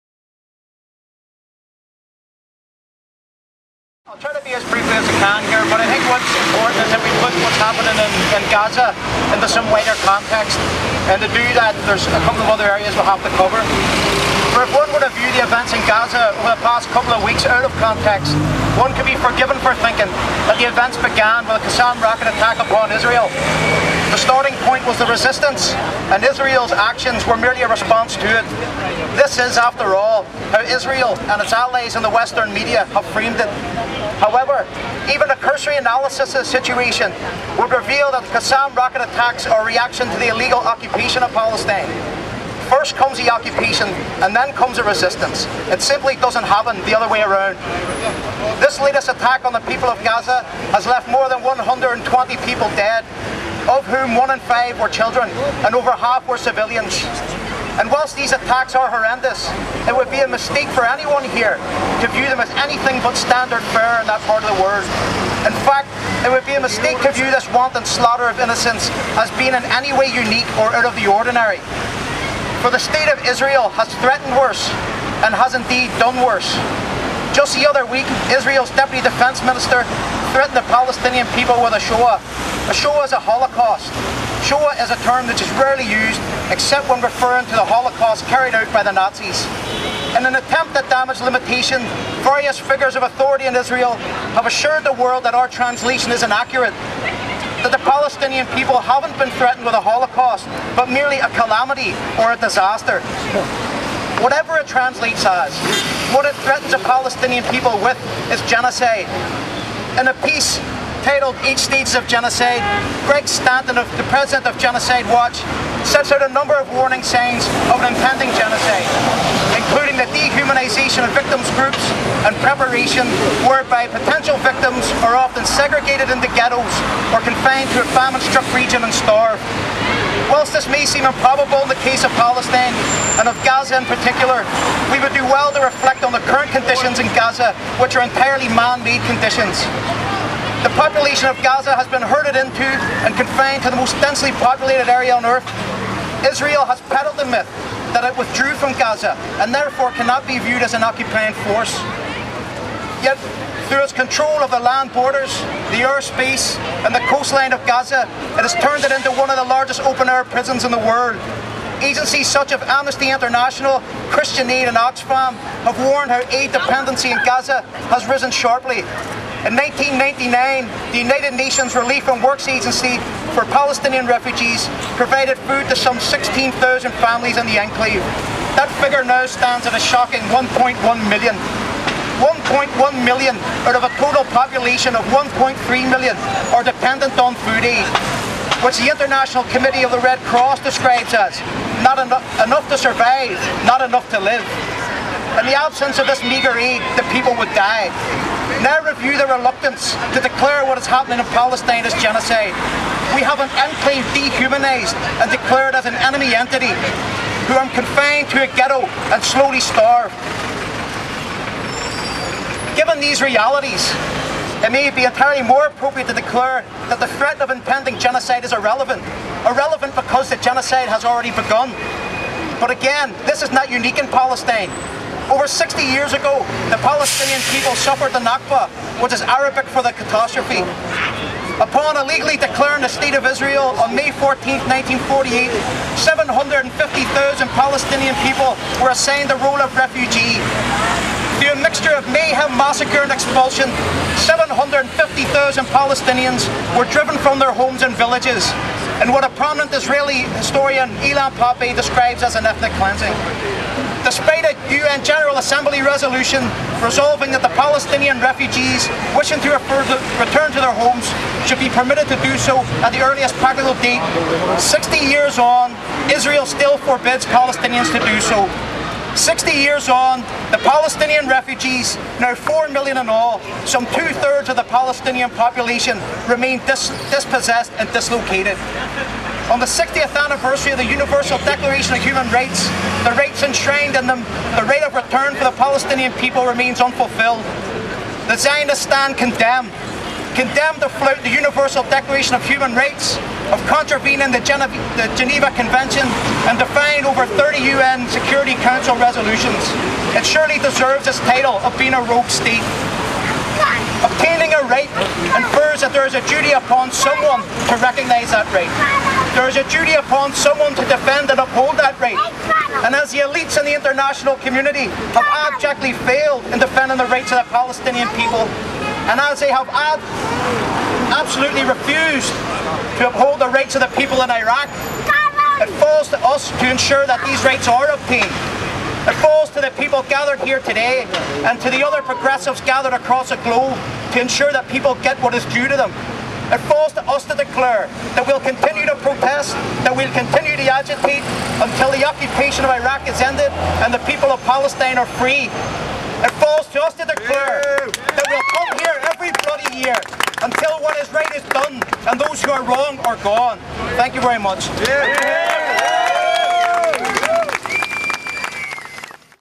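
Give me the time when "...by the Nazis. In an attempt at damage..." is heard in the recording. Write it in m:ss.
1:28.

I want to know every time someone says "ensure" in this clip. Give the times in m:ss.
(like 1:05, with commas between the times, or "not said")
5:26, 5:34.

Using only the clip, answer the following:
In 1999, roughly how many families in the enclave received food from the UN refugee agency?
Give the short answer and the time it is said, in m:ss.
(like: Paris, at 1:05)
16,000, at 2:55.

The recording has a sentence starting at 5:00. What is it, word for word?
It surely deserves its title of being a rogue state.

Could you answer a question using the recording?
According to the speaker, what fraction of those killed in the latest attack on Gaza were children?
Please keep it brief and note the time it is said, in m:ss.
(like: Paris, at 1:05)
one in five, at 0:54.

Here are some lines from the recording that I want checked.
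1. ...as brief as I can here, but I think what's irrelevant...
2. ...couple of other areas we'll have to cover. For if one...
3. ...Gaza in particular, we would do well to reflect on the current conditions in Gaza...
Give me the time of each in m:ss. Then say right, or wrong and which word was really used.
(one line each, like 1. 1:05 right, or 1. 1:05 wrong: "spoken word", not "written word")
1. 0:04 wrong: "important", not "irrelevant"
2. 0:12 right
3. 2:13 right.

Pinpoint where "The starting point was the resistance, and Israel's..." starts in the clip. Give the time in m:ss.
0:24.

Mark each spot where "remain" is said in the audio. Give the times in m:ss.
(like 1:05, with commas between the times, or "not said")
4:36, 4:46.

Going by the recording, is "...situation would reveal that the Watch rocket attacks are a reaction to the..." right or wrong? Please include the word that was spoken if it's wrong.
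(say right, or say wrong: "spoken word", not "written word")
wrong: "Qassam", not "Watch".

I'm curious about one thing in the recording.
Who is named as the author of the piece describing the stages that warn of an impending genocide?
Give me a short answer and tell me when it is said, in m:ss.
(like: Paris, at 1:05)
Greg Stanton, at 1:53.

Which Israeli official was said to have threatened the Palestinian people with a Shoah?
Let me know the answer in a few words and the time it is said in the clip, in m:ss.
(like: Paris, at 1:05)
Deputy Defense Minister, at 1:18.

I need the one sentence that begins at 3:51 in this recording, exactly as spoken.
Upon illegally declaring the State of Israel on May 14, 1948, 750,000 Palestinian people were assigned the role of refugee.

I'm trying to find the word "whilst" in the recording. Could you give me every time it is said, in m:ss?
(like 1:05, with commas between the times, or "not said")
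0:57, 2:10.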